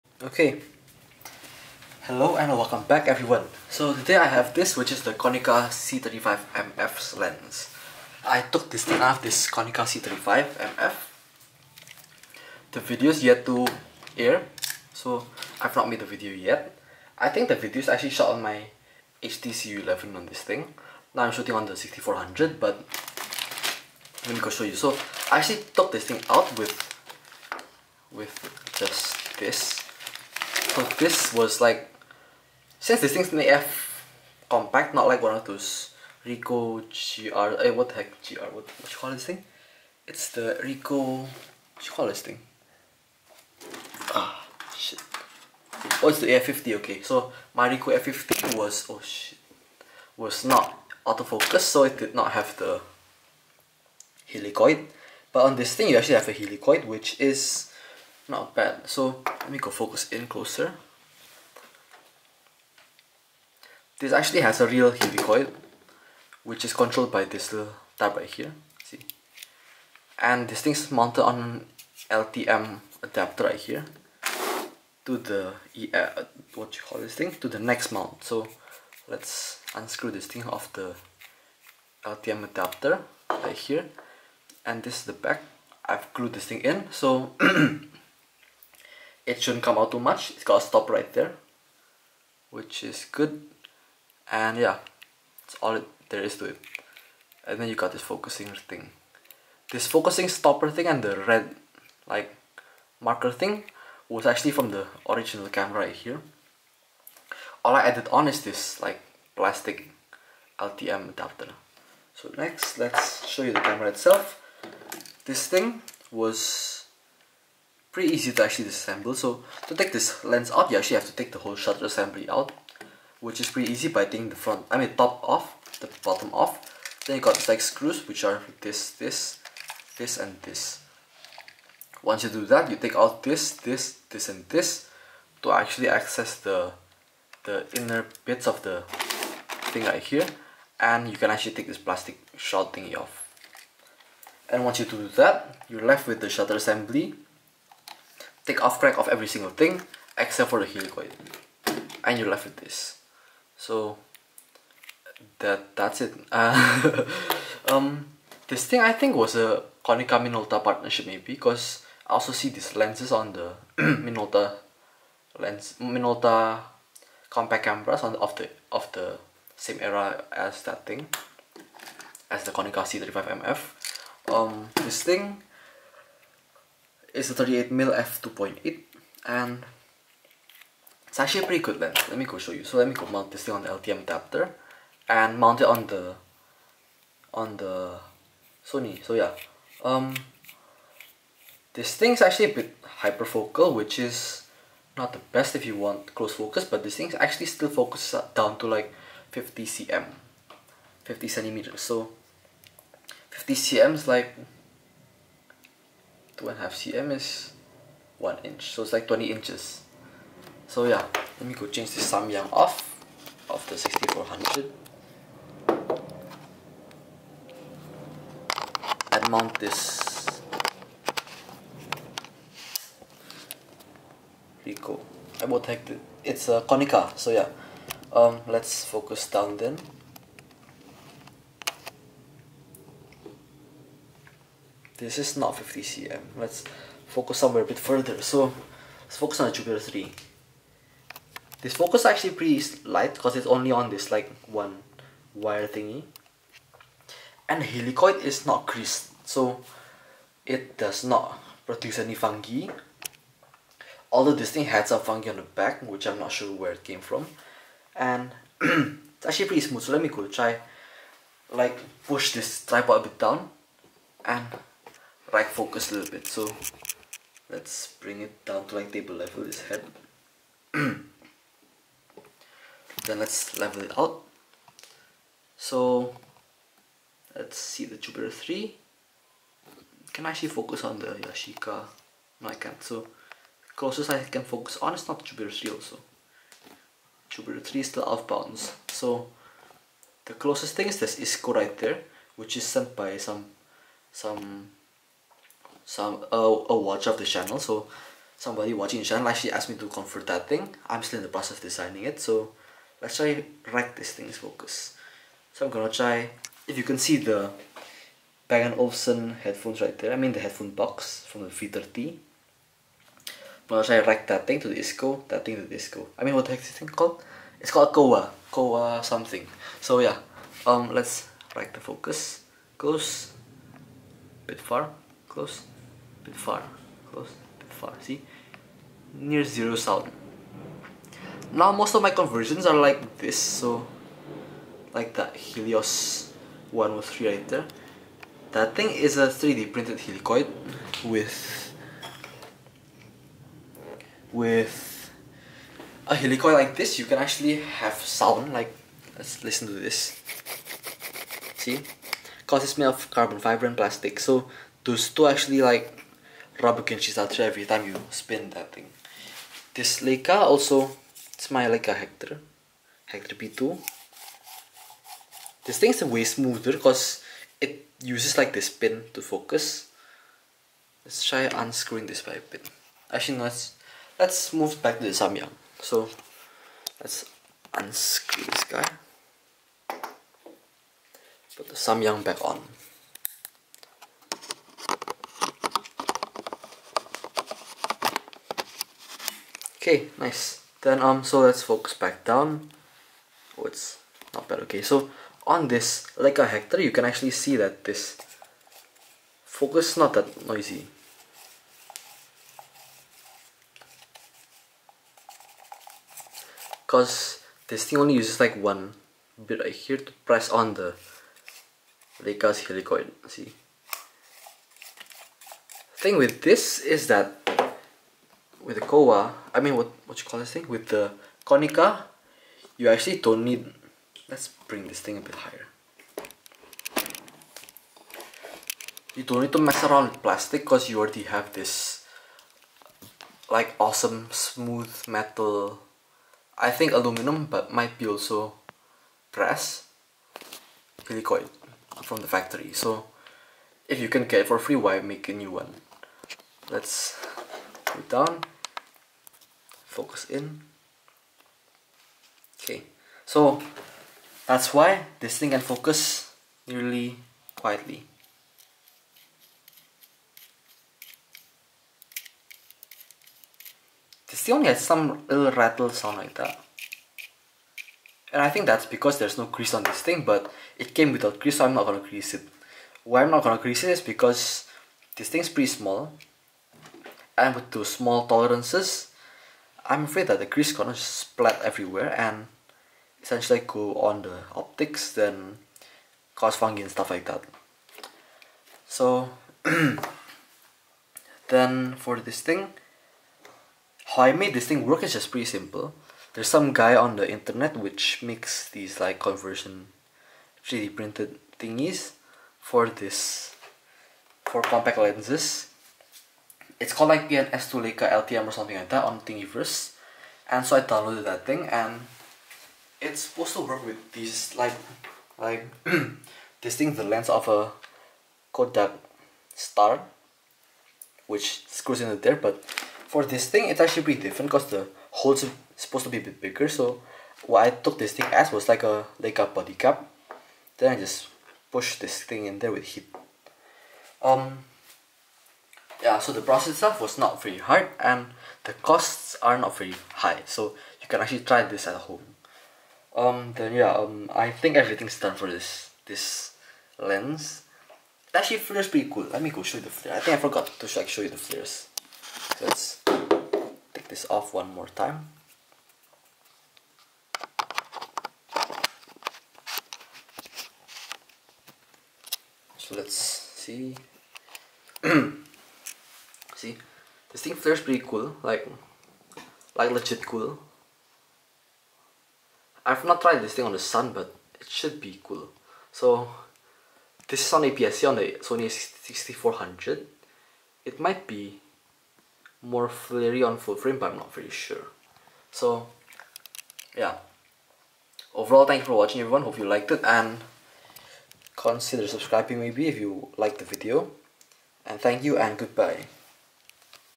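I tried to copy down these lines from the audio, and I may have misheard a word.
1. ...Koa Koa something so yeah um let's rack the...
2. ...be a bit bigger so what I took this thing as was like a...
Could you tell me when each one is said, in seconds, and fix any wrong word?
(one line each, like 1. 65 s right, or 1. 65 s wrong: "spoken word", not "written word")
1. 317 s right
2. 526 s right.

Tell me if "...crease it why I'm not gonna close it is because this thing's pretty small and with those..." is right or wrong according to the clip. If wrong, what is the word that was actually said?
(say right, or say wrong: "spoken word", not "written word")
wrong: "crease", not "close".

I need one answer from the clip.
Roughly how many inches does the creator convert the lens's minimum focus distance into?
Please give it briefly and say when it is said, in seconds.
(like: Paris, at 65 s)
20 inches, at 209 s.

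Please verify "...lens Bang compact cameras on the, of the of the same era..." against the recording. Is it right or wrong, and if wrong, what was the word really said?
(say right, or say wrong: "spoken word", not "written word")
wrong: "Minolta", not "Bang".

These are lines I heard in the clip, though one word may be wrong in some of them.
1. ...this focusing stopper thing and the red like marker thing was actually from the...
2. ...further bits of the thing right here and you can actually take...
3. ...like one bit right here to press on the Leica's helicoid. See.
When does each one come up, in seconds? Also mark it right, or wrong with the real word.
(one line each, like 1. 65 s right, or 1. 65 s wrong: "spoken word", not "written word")
1. 99 s right
2. 137 s wrong: "inner", not "further"
3. 408 s right.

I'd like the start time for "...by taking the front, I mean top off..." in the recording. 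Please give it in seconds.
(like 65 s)
123 s.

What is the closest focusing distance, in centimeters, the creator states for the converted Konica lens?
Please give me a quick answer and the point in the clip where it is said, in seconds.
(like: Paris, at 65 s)
50 cm, at 201 s.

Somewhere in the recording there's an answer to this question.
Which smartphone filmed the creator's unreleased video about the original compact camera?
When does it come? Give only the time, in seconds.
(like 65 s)
19 s.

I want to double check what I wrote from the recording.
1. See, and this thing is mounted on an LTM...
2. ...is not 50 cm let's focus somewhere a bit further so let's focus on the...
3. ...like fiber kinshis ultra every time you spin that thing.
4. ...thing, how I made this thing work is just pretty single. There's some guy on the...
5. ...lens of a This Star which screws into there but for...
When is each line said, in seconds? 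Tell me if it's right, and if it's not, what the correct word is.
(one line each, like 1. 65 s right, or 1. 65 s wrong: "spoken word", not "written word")
1. 68 s right
2. 235 s right
3. 355 s wrong: "rubber", not "fiber"
4. 492 s wrong: "simple", not "single"
5. 517 s wrong: "Kodak", not "This".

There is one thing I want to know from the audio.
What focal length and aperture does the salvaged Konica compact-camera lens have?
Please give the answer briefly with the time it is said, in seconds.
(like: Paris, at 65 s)
38mm f2.8, at 177 s.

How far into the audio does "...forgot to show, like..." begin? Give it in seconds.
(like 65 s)
550 s.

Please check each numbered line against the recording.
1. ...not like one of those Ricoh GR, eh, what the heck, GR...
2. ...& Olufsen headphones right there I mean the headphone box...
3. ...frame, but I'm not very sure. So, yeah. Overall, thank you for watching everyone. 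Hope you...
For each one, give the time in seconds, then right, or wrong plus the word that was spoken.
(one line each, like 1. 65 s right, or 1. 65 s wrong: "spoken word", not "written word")
1. 34 s right
2. 308 s right
3. 583 s right.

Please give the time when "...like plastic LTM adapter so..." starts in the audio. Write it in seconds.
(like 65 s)
108 s.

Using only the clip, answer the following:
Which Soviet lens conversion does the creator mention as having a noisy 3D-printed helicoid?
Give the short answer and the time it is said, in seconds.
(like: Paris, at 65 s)
Helios 103, at 335 s.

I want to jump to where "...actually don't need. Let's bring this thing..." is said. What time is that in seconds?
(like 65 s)
422 s.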